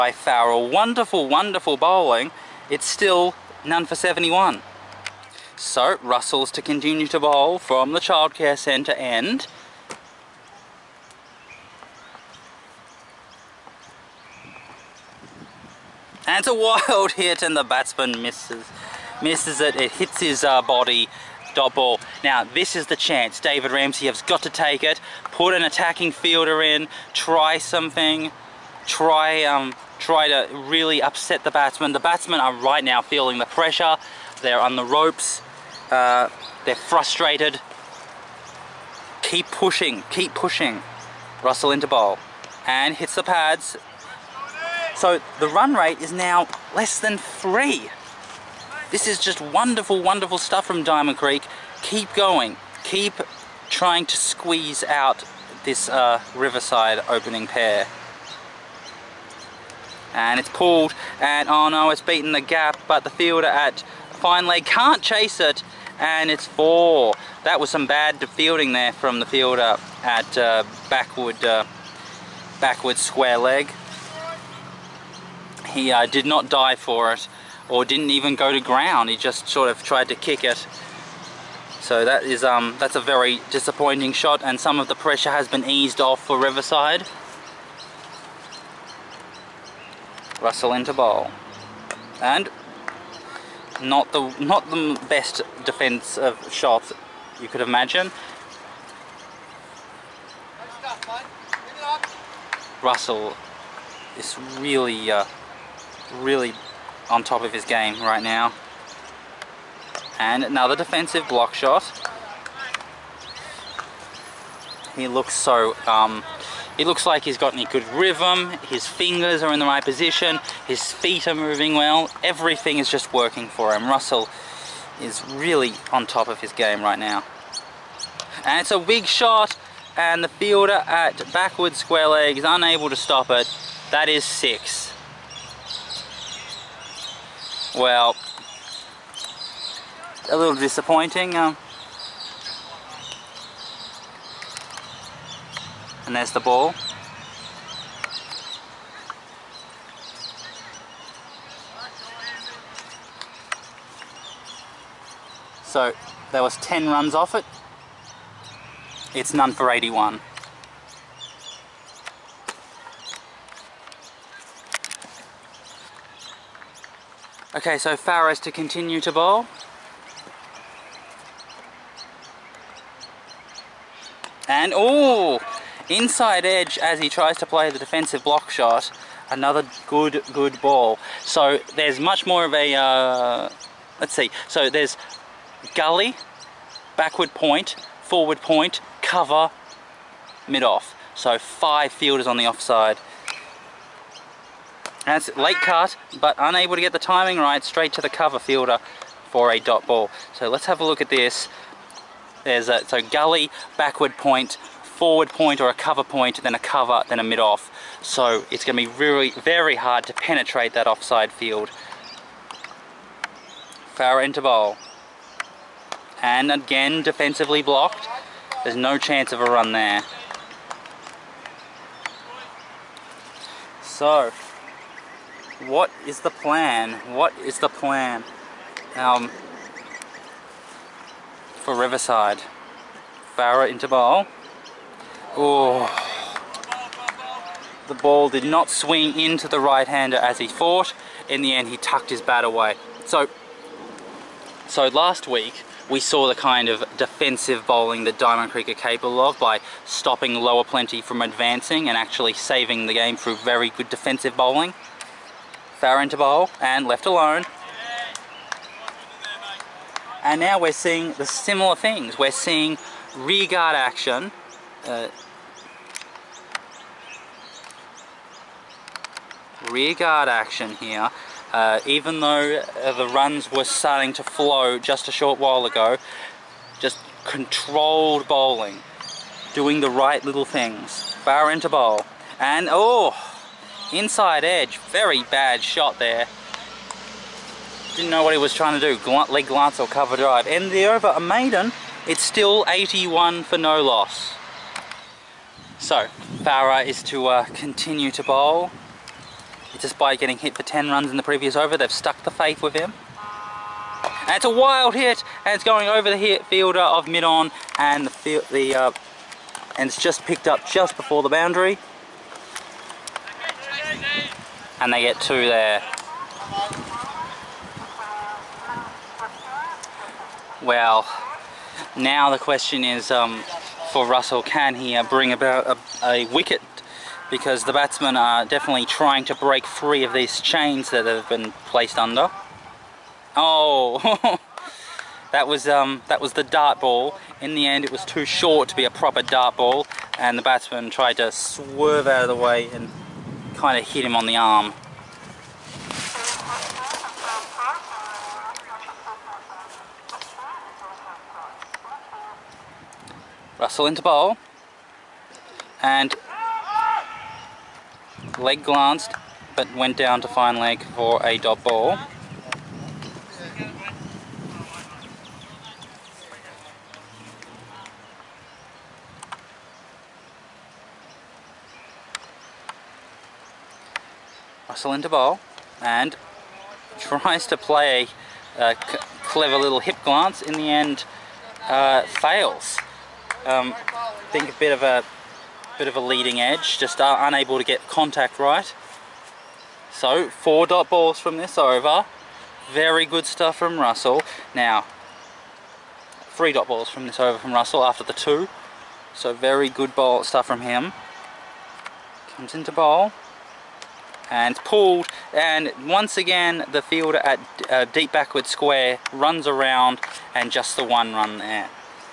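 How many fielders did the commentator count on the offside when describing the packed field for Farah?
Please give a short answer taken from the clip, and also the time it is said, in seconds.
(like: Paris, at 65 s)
5, at 191 s.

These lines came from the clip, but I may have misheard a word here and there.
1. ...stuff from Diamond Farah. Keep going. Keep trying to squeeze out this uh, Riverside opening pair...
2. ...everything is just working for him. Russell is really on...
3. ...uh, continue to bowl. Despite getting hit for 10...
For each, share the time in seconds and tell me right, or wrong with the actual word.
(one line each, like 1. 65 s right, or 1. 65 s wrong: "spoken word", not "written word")
1. 50 s wrong: "Creek", not "Farah"
2. 122 s right
3. 297 s right.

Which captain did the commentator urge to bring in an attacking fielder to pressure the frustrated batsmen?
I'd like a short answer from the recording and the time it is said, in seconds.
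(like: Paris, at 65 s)
David Ramsey, at 23 s.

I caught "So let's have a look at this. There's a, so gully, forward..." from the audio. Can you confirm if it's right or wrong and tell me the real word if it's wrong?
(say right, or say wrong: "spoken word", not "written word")
wrong: "backward", not "forward".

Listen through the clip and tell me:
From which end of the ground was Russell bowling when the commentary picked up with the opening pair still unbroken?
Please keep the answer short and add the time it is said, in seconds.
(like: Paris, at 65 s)
Childcare centre end, at 7 s.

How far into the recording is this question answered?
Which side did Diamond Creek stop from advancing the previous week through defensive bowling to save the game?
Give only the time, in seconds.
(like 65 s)
250 s.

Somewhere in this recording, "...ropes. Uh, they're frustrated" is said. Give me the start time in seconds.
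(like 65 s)
34 s.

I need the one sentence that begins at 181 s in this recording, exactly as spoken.
So there's much more of a, uh, let's see.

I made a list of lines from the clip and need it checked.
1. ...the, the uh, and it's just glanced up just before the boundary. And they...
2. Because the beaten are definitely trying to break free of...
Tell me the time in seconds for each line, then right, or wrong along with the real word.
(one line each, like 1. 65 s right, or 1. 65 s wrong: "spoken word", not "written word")
1. 308 s wrong: "picked", not "glanced"
2. 327 s wrong: "batsmen", not "beaten".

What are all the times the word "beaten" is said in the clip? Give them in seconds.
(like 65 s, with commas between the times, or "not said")
61 s.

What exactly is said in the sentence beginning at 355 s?
And leg glanced, but went down to fine leg for a dot ball.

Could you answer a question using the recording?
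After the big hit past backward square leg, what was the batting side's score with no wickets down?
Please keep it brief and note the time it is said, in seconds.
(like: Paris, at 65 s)
81, at 159 s.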